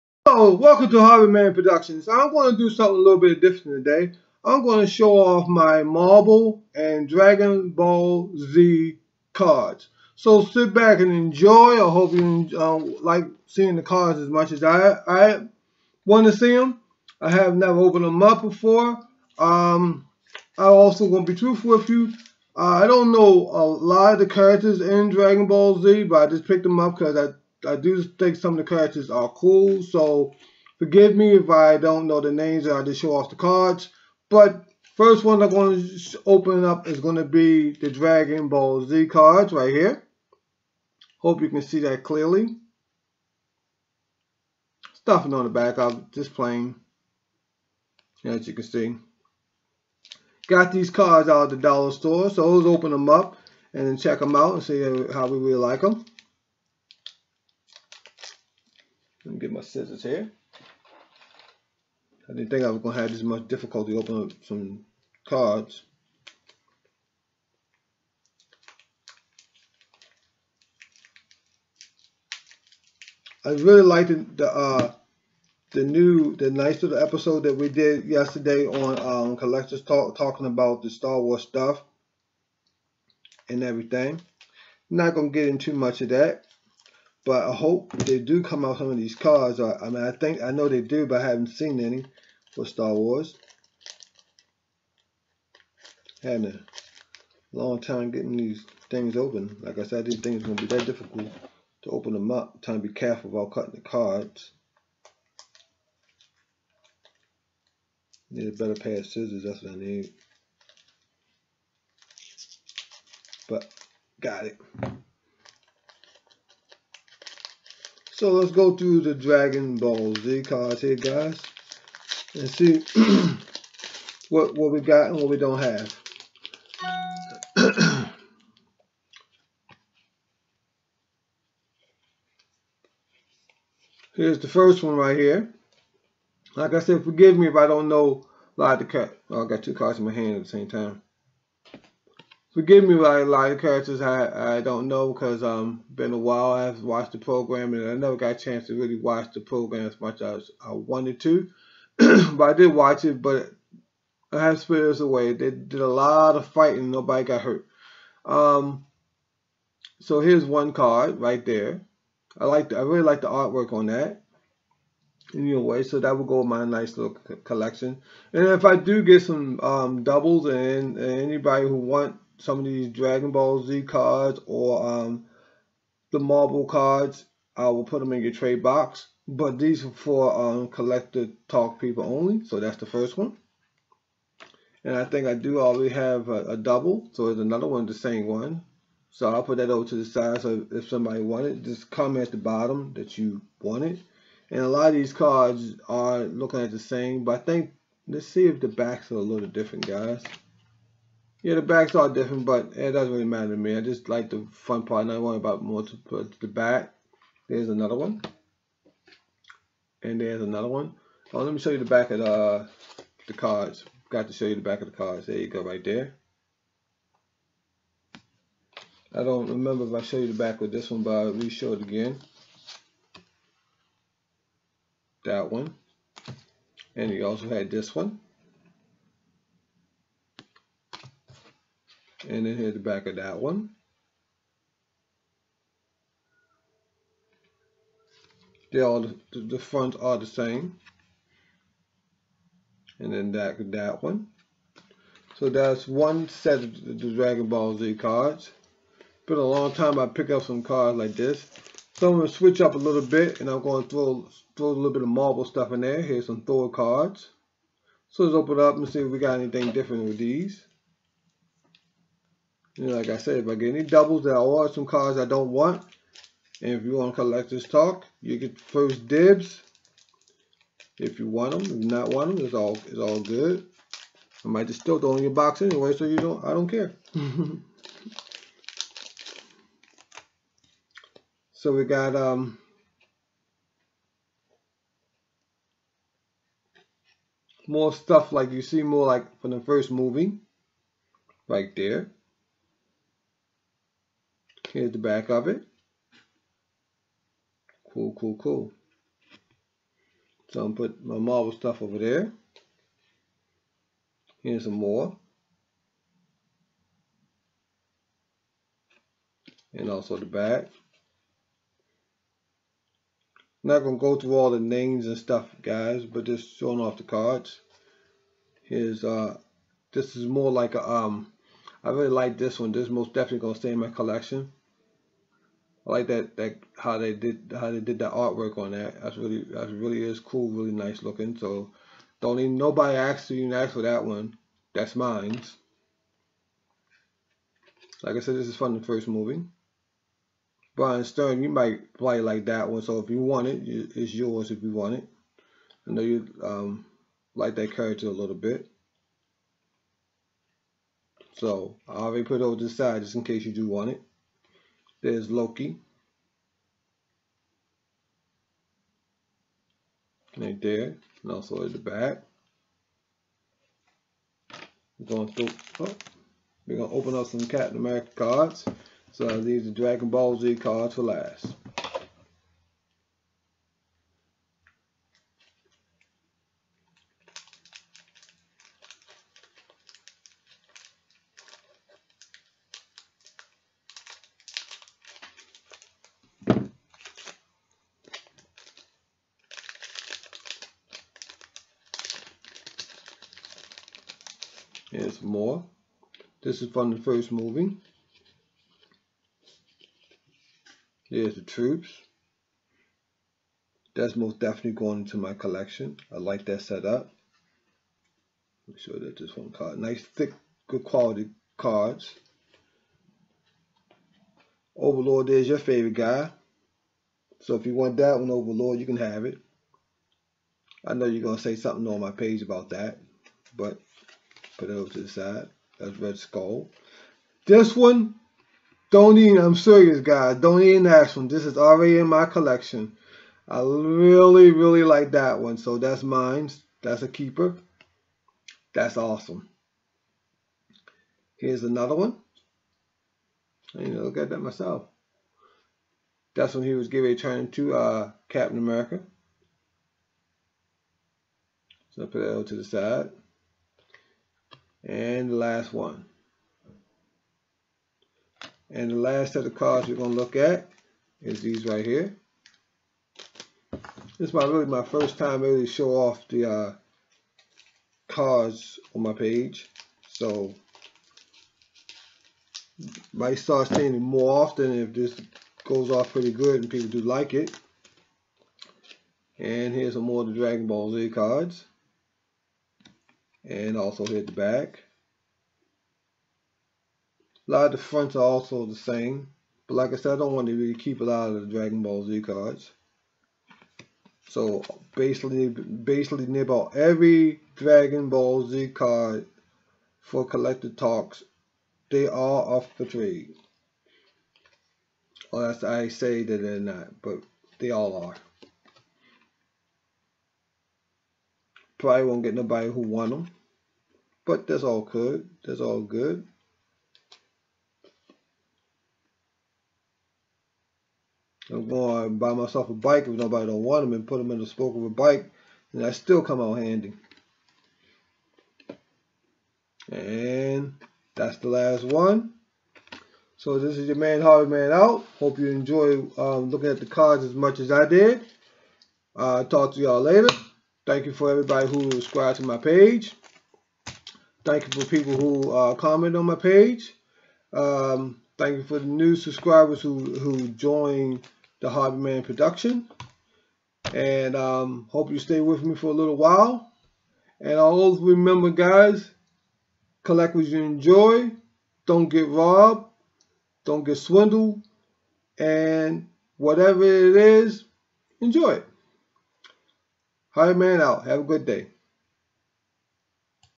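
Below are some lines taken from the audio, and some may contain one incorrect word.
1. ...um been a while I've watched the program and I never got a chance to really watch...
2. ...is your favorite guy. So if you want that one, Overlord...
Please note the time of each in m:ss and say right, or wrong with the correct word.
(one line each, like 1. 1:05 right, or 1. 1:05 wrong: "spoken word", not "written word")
1. 2:25 right
2. 6:55 right.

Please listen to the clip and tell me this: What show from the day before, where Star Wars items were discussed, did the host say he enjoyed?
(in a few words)
Collectors Talk.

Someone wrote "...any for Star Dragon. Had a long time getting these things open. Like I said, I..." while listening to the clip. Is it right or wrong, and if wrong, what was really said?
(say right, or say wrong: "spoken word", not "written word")
wrong: "Wars", not "Dragon".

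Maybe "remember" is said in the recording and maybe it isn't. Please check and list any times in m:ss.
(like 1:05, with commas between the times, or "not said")
3:39, 9:18.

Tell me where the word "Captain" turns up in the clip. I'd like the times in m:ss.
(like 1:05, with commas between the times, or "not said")
6:07, 7:28.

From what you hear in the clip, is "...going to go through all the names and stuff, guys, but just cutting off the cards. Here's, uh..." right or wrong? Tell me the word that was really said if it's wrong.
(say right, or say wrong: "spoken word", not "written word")
wrong: "showing", not "cutting".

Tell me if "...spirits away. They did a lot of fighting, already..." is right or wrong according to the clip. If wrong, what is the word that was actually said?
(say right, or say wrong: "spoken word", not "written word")
wrong: "nobody", not "already".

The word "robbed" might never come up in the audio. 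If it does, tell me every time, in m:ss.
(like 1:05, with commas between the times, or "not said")
9:22.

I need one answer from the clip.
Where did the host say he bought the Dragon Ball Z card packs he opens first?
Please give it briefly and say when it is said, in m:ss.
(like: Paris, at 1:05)
The dollar store, at 0:51.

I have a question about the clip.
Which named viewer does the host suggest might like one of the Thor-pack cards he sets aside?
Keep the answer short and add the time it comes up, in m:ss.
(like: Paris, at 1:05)
Brian Stern, at 5:40.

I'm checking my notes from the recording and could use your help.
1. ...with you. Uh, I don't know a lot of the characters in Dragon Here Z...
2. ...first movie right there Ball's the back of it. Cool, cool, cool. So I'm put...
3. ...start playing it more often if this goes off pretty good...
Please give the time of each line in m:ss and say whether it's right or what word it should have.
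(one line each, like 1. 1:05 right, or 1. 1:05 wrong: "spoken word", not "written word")
1. 0:21 wrong: "Ball", not "Here"
2. 4:49 wrong: "Here", not "Ball"
3. 7:53 wrong: "seeing", not "playing".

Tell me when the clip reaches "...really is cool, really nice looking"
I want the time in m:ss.
5:29.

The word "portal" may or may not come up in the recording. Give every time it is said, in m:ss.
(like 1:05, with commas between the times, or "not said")
not said.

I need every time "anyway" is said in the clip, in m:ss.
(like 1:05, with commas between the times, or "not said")
2:45, 4:35.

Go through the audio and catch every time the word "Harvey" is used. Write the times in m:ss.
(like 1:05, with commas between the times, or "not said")
0:01, 8:54, 9:11.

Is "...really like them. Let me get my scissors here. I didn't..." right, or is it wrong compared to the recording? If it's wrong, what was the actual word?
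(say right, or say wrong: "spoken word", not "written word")
right.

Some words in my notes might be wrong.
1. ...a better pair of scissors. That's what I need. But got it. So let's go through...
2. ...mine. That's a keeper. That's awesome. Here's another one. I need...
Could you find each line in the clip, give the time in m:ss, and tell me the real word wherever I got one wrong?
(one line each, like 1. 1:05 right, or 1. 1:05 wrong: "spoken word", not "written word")
1. 1:48 right
2. 7:16 right.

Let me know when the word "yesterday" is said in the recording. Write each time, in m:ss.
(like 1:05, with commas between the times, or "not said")
1:18.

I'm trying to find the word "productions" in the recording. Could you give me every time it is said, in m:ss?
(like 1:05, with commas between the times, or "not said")
0:01, 9:12.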